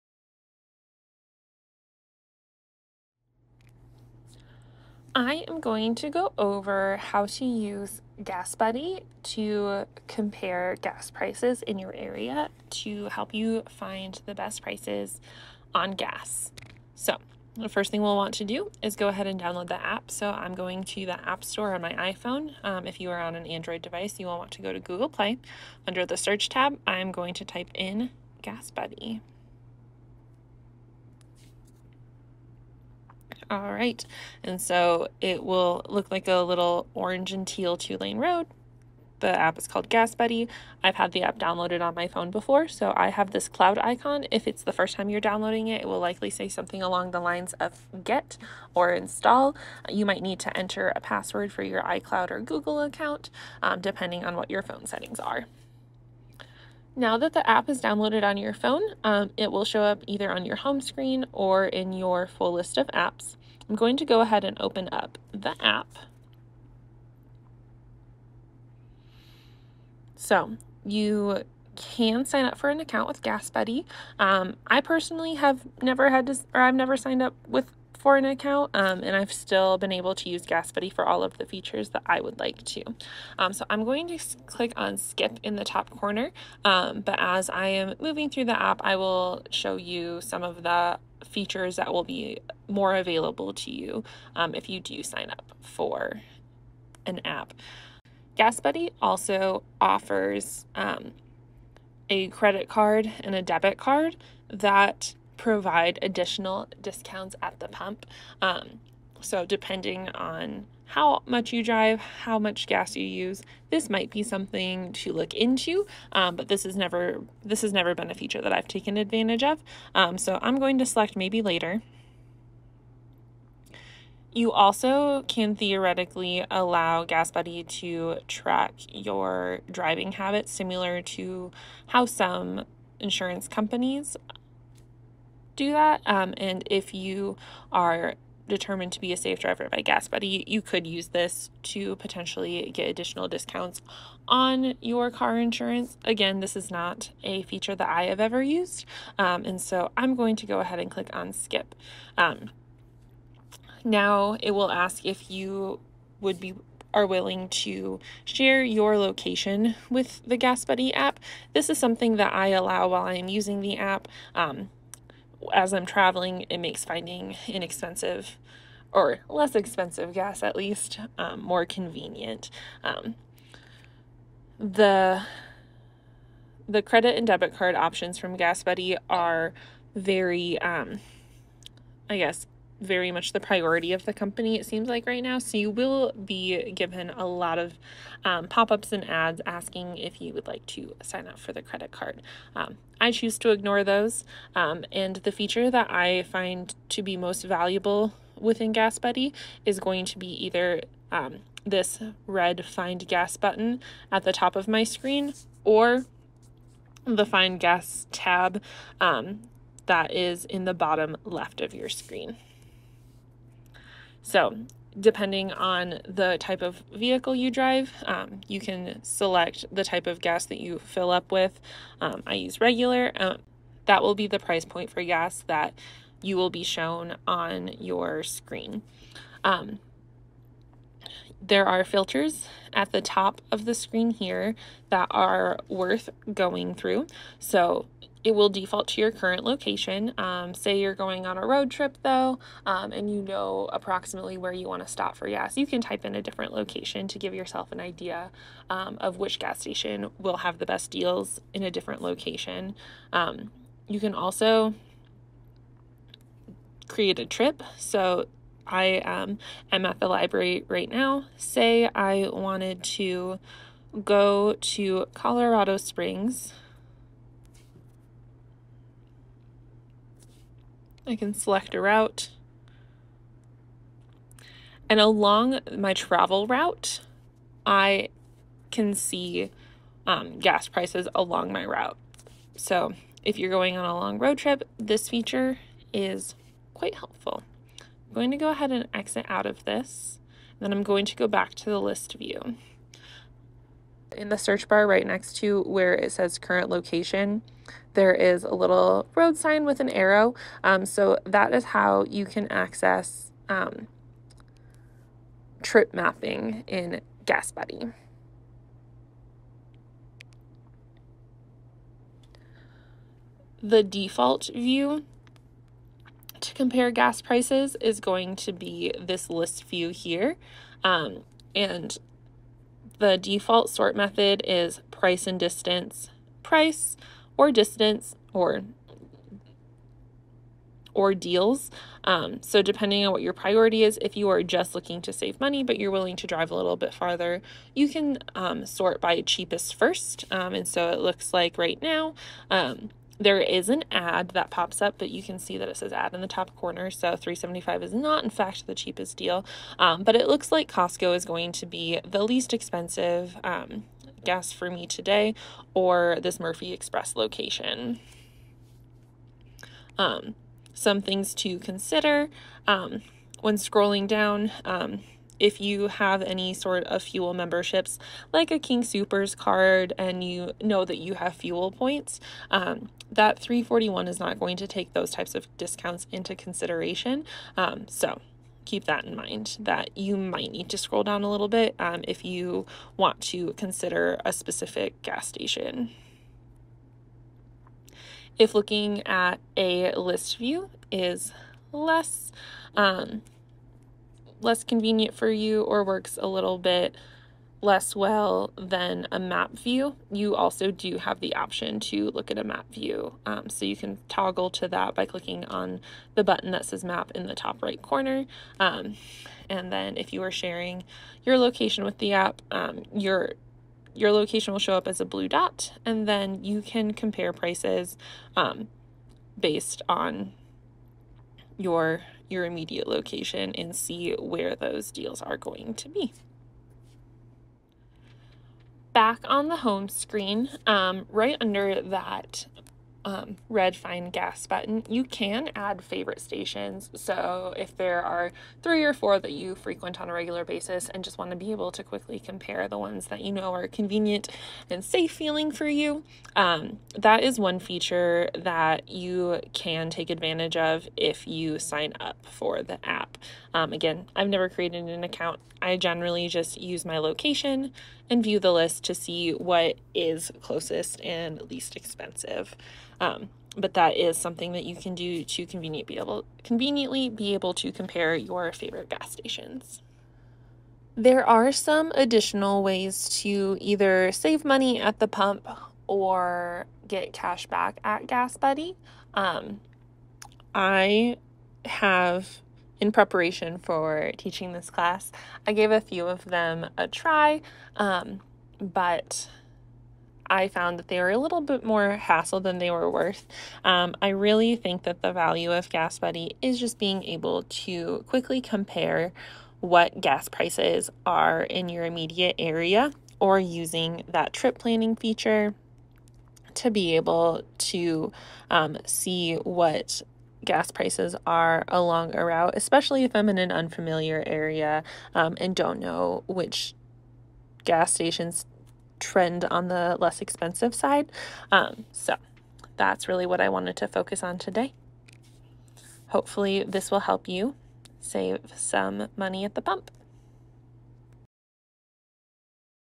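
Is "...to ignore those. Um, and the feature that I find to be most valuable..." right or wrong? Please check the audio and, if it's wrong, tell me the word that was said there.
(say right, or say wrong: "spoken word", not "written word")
right.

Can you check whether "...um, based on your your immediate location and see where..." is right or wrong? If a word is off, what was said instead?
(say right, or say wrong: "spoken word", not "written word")
right.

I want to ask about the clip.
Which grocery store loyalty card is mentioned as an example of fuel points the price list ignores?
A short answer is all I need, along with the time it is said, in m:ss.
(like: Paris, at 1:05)
King Supers, at 6:08.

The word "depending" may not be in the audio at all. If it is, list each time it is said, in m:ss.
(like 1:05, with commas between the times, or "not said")
0:53, 1:49, 3:34, 5:32.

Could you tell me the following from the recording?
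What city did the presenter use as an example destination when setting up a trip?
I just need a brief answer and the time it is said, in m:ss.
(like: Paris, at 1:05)
Colorado Springs, at 4:25.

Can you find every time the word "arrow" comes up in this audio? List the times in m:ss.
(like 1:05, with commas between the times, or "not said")
4:59.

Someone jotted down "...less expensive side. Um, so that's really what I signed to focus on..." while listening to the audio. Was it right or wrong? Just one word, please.
wrong.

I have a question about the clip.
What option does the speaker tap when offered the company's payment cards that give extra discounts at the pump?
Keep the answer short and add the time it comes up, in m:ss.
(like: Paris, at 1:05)
maybe later, at 2:01.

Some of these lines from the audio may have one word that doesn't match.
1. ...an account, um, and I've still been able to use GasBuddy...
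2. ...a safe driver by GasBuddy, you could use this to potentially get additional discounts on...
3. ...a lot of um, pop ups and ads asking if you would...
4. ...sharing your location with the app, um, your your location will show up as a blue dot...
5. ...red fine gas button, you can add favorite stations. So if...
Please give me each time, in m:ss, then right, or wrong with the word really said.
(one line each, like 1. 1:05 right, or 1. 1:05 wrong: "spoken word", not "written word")
1. 1:18 right
2. 2:19 right
3. 3:07 right
4. 6:50 right
5. 7:13 right.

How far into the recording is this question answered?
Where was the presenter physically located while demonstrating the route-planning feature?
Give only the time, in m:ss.
4:19.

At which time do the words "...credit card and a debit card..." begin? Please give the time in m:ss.
1:42.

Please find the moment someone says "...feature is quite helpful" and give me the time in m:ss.
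4:45.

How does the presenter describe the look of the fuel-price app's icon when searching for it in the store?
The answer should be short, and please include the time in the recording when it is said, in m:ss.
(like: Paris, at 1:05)
orange and teal two lane road, at 0:36.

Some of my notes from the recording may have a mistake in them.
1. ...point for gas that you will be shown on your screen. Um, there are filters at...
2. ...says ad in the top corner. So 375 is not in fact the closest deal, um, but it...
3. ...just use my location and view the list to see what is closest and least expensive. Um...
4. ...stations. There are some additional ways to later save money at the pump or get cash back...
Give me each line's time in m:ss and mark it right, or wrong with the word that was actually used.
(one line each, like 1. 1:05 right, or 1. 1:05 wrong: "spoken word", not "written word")
1. 3:44 right
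2. 5:45 wrong: "cheapest", not "closest"
3. 7:36 right
4. 7:49 wrong: "either", not "later".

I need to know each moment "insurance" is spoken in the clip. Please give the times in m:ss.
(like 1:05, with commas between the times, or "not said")
2:12, 2:25.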